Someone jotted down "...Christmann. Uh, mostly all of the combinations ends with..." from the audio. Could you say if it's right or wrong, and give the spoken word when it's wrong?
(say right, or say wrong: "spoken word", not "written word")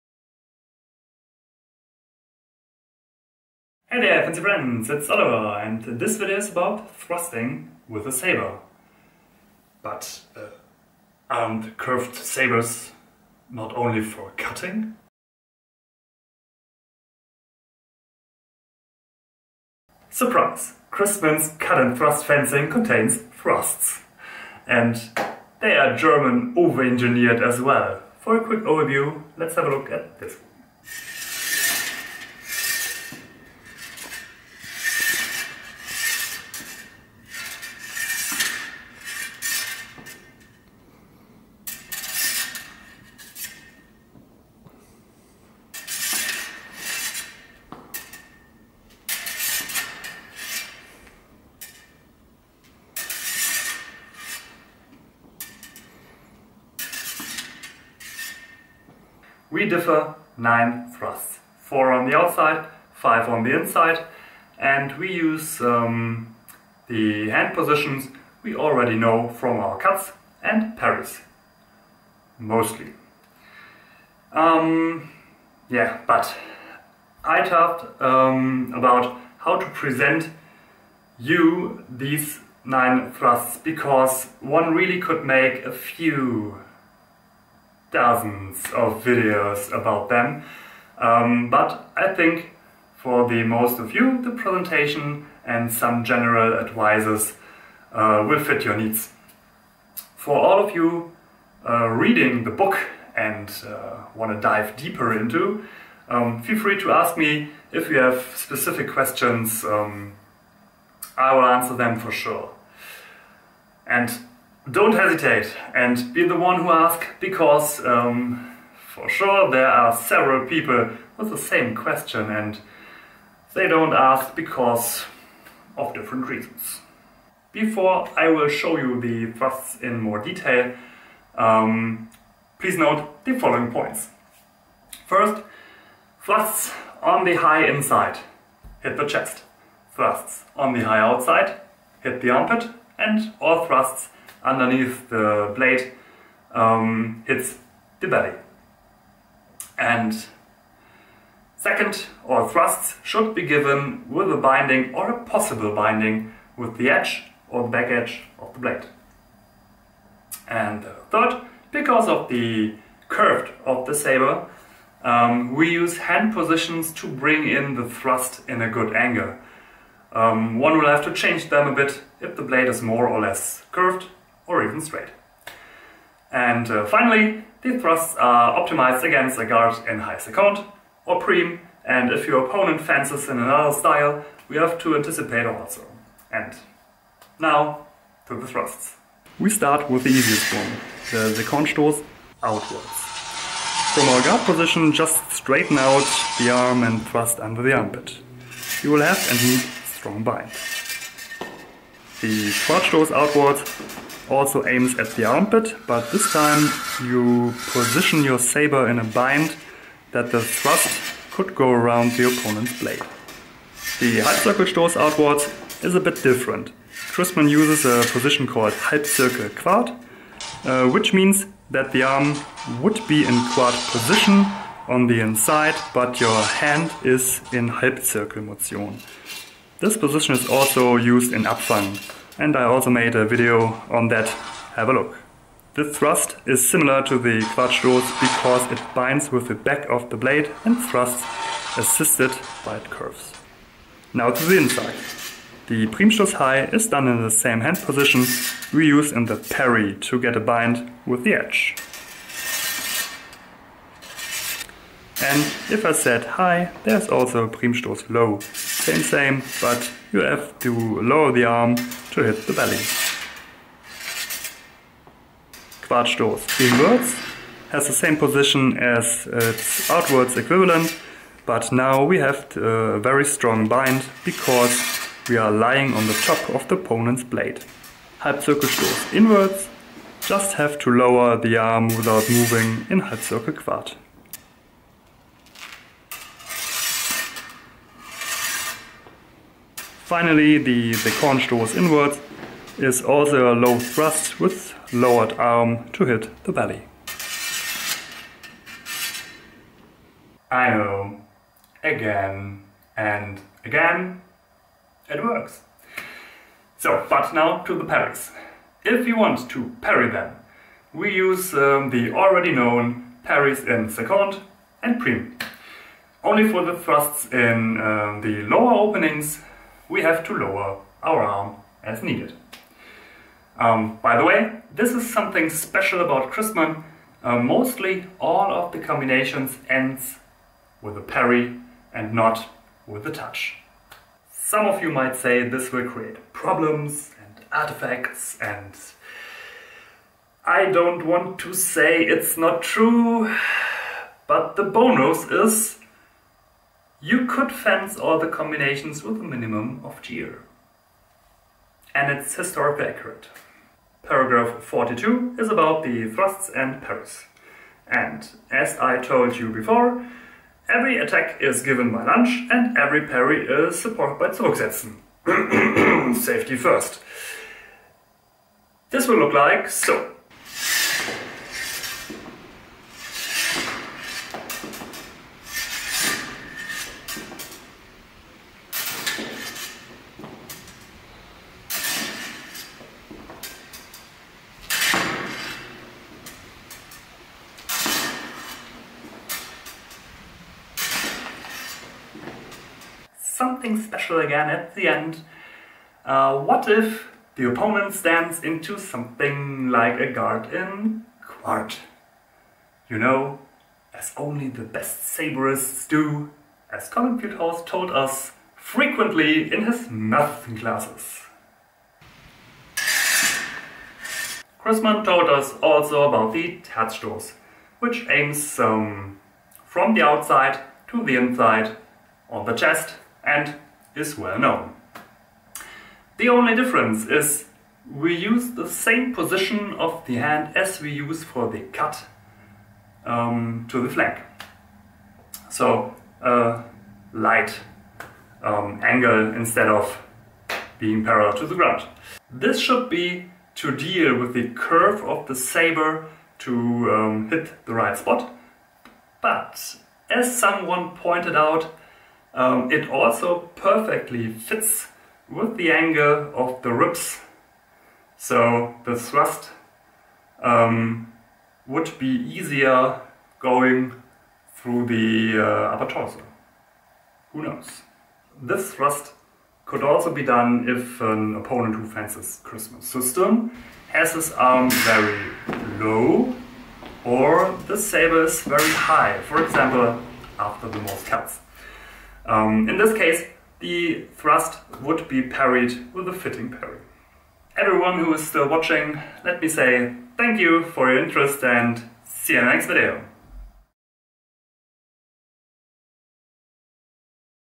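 right.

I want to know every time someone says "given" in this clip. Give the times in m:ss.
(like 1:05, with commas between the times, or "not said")
2:33, 6:01.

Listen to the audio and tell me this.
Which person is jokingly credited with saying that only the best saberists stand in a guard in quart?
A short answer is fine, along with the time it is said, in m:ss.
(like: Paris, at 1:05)
Colin Putehouse, at 6:46.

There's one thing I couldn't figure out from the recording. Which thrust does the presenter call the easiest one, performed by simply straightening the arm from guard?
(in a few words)
second stoß outwards.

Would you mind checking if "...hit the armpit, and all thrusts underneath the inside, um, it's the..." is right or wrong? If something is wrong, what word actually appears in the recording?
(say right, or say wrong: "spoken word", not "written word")
wrong: "blade", not "inside".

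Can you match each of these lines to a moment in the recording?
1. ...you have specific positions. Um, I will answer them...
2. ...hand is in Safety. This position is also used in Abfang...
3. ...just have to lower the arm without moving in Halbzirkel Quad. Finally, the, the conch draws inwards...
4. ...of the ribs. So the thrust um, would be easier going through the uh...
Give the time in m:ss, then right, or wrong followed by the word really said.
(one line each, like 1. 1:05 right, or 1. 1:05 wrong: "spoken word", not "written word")
1. 1:47 wrong: "questions", not "positions"
2. 3:46 wrong: "Halbzirkelmotion", not "Safety"
3. 4:40 right
4. 7:36 right.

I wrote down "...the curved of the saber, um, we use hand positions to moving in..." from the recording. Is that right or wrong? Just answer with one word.
wrong.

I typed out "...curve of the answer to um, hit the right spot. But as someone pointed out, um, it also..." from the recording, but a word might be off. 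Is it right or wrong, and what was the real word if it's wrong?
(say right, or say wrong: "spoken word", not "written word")
wrong: "saber", not "answer".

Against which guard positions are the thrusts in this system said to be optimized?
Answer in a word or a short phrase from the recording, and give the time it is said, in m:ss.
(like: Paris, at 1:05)
high second or prim, at 2:59.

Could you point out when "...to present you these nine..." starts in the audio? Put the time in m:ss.
1:19.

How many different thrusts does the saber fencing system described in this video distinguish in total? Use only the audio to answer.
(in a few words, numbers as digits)
9.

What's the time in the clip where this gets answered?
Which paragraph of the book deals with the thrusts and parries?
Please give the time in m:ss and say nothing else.
5:54.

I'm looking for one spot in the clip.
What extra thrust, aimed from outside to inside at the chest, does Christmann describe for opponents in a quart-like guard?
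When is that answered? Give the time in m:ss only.
6:56.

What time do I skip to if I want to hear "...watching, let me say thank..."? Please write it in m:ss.
8:08.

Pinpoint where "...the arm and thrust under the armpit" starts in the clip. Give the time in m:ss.
3:16.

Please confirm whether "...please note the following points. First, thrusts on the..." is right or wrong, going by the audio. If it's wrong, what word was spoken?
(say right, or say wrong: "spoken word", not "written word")
right.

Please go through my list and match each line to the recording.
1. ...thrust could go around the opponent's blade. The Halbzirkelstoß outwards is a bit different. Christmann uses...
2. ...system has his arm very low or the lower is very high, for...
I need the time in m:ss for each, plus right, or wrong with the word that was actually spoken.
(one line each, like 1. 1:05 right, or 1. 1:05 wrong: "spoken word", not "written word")
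1. 3:30 right
2. 7:52 wrong: "saber", not "lower".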